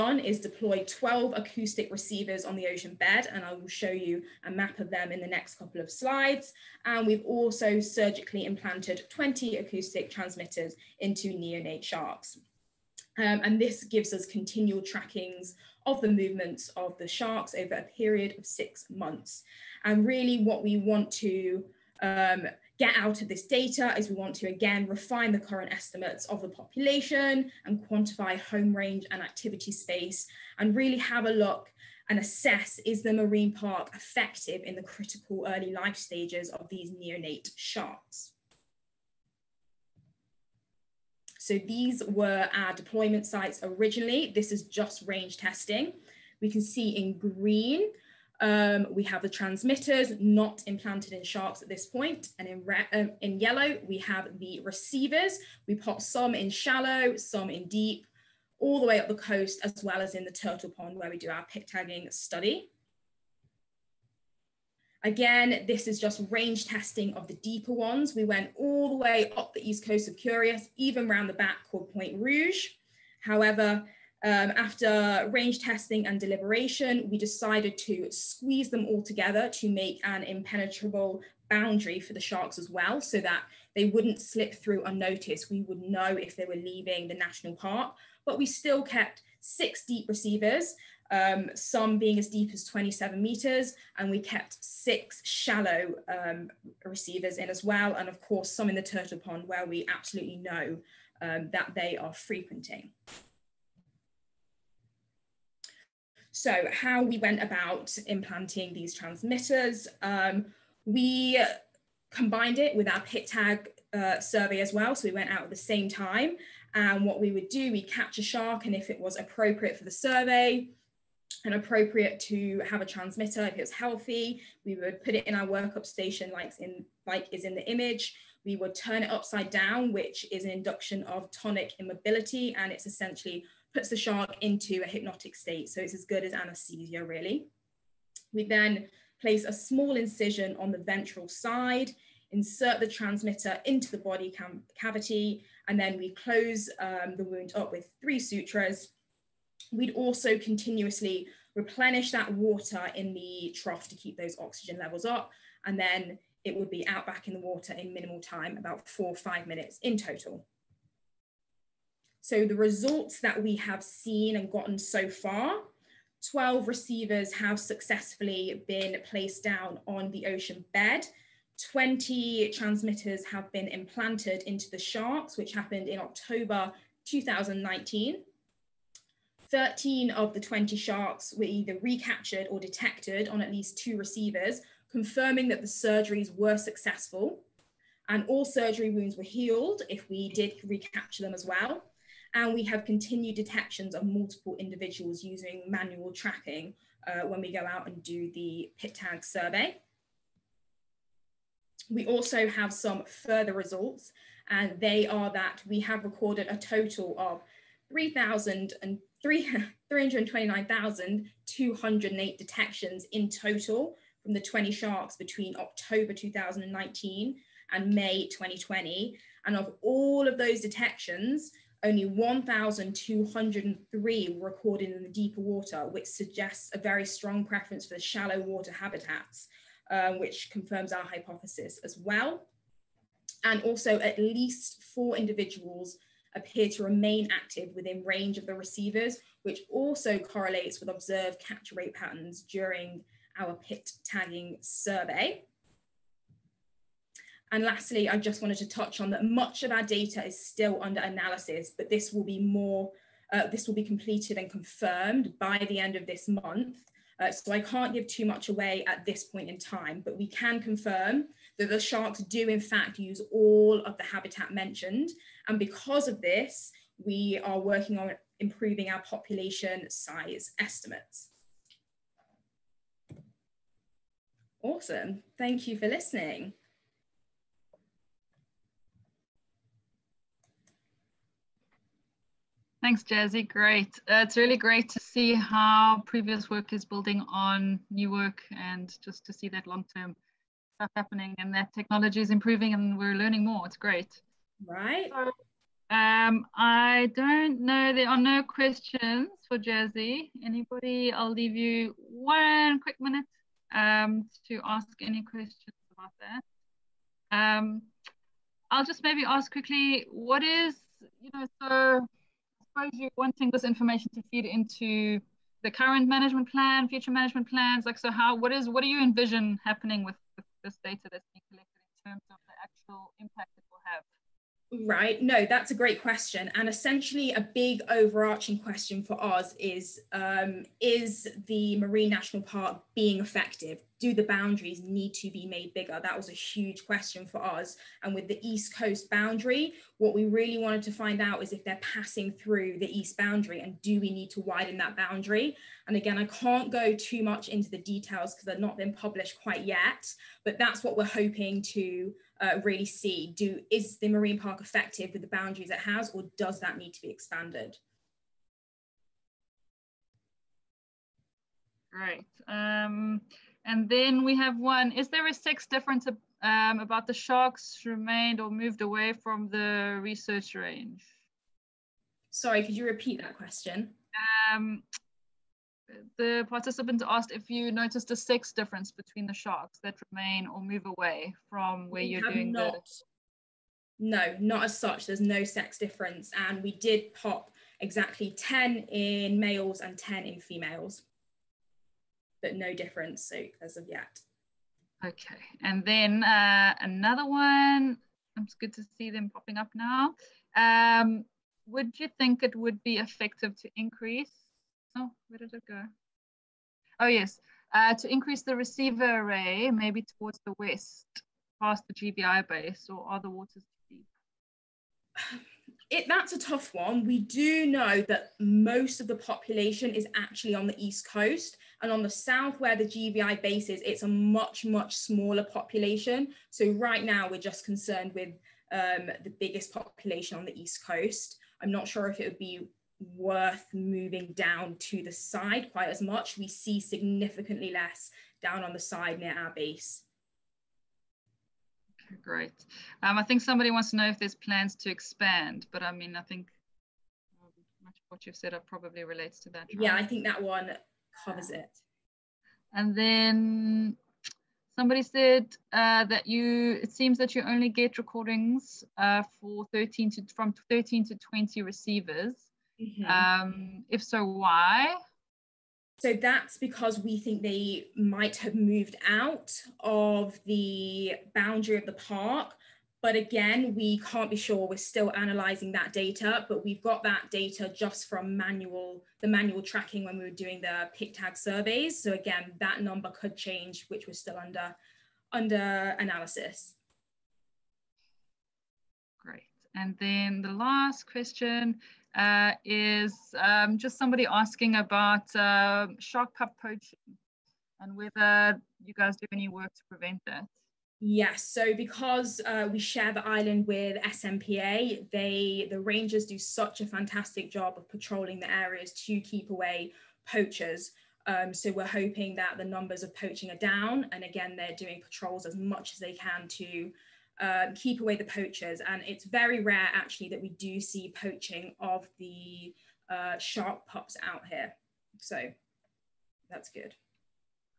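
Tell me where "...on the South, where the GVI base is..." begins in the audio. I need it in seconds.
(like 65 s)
421 s.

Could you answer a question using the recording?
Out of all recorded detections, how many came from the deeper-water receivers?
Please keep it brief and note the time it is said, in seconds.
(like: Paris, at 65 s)
1,203, at 222 s.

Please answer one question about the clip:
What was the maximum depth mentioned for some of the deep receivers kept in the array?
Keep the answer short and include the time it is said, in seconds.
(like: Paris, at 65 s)
27 meters, at 92 s.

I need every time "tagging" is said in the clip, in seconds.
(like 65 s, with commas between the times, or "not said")
61 s, 244 s.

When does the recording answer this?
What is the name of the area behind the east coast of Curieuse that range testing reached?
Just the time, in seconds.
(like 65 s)
71 s.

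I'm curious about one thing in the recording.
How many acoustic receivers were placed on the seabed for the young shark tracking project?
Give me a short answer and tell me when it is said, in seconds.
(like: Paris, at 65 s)
12, at 0 s.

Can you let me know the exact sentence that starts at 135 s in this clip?
So it's as good as anesthesia, really.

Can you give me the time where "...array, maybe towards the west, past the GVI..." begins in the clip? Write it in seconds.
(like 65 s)
409 s.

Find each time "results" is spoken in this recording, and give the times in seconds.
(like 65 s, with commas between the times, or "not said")
162 s, 203 s.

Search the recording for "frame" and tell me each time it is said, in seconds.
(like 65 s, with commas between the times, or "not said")
not said.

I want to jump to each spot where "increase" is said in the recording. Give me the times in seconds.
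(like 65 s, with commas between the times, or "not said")
403 s, 408 s.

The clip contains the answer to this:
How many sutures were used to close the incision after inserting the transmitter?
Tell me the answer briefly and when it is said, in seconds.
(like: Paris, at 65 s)
3, at 148 s.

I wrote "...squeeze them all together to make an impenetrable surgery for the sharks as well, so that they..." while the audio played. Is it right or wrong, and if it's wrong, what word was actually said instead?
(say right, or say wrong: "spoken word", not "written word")
wrong: "boundary", not "surgery".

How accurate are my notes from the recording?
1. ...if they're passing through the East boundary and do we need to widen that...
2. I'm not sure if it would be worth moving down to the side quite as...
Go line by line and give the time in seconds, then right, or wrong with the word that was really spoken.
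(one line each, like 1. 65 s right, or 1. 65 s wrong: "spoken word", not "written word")
1. 341 s right
2. 431 s right.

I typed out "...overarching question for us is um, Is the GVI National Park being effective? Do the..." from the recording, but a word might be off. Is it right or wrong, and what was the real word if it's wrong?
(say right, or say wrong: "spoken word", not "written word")
wrong: "Marine", not "GVI".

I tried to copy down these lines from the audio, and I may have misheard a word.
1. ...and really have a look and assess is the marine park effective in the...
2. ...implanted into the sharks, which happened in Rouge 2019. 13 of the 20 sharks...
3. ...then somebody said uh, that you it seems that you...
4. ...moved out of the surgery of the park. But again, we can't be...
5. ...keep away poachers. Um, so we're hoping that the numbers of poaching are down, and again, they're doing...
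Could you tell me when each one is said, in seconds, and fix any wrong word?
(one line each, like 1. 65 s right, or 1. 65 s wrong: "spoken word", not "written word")
1. 30 s right
2. 173 s wrong: "October", not "Rouge"
3. 452 s right
4. 468 s wrong: "boundary", not "surgery"
5. 509 s right.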